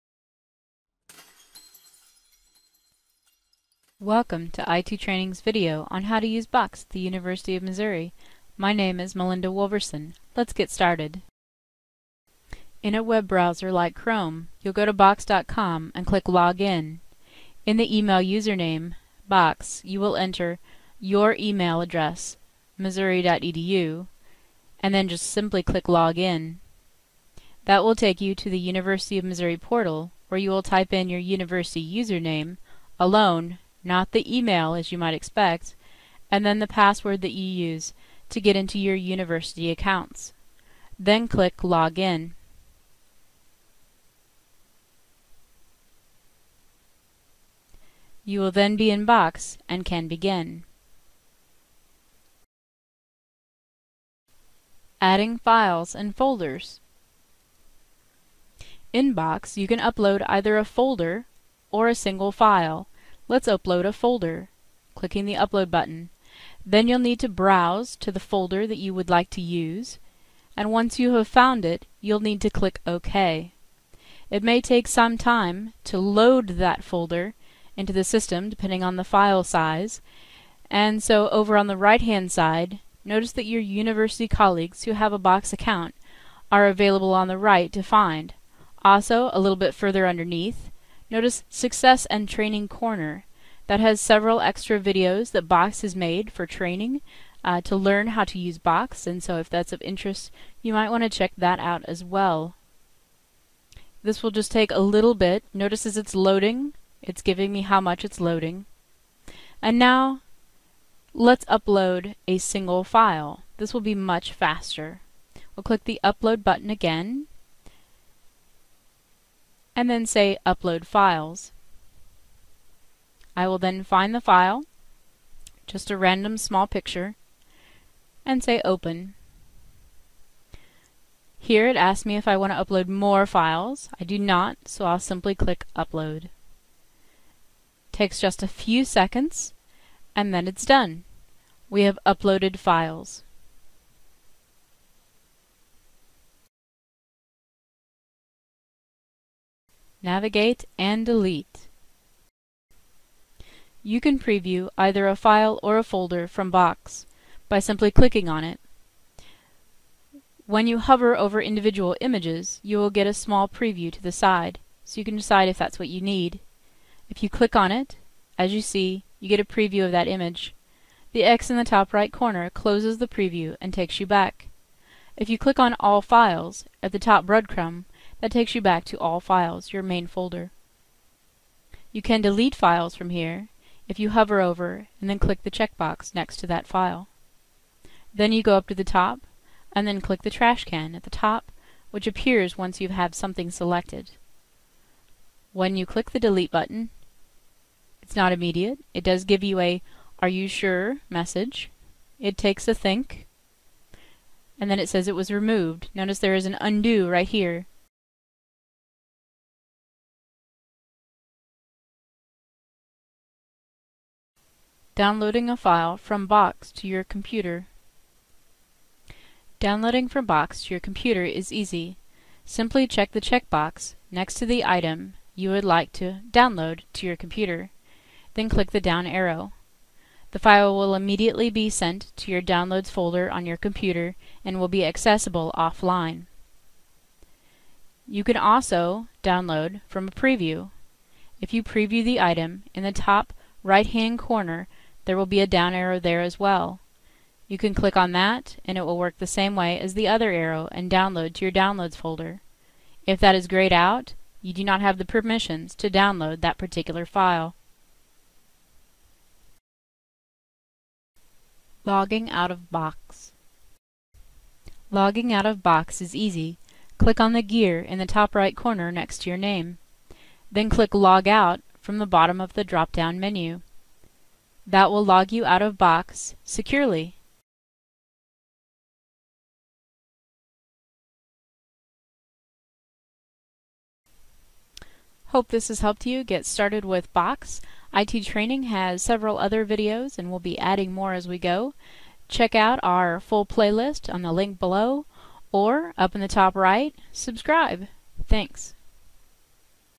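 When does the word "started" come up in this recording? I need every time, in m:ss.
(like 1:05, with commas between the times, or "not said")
0:10, 4:46.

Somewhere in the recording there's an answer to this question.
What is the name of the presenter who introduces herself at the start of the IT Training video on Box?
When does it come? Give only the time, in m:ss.
0:09.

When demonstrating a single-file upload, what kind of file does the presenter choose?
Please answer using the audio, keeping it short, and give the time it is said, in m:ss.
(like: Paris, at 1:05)
small picture, at 2:06.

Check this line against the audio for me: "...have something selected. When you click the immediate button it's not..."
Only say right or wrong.
wrong.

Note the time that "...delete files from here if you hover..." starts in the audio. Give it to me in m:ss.
3:02.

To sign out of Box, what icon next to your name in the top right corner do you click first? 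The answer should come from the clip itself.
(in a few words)
the gear.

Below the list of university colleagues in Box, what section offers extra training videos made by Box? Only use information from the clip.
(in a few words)
Success and Training Corner.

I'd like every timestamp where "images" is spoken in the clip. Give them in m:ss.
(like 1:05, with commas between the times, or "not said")
2:42, 2:50.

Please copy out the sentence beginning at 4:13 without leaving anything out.
If that is grayed out, you do not have the permissions to download that particular file.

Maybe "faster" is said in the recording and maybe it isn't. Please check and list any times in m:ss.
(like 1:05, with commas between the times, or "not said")
1:54.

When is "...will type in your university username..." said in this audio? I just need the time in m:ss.
0:30.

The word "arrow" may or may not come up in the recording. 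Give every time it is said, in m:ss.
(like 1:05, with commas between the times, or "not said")
3:49, 4:05, 4:10.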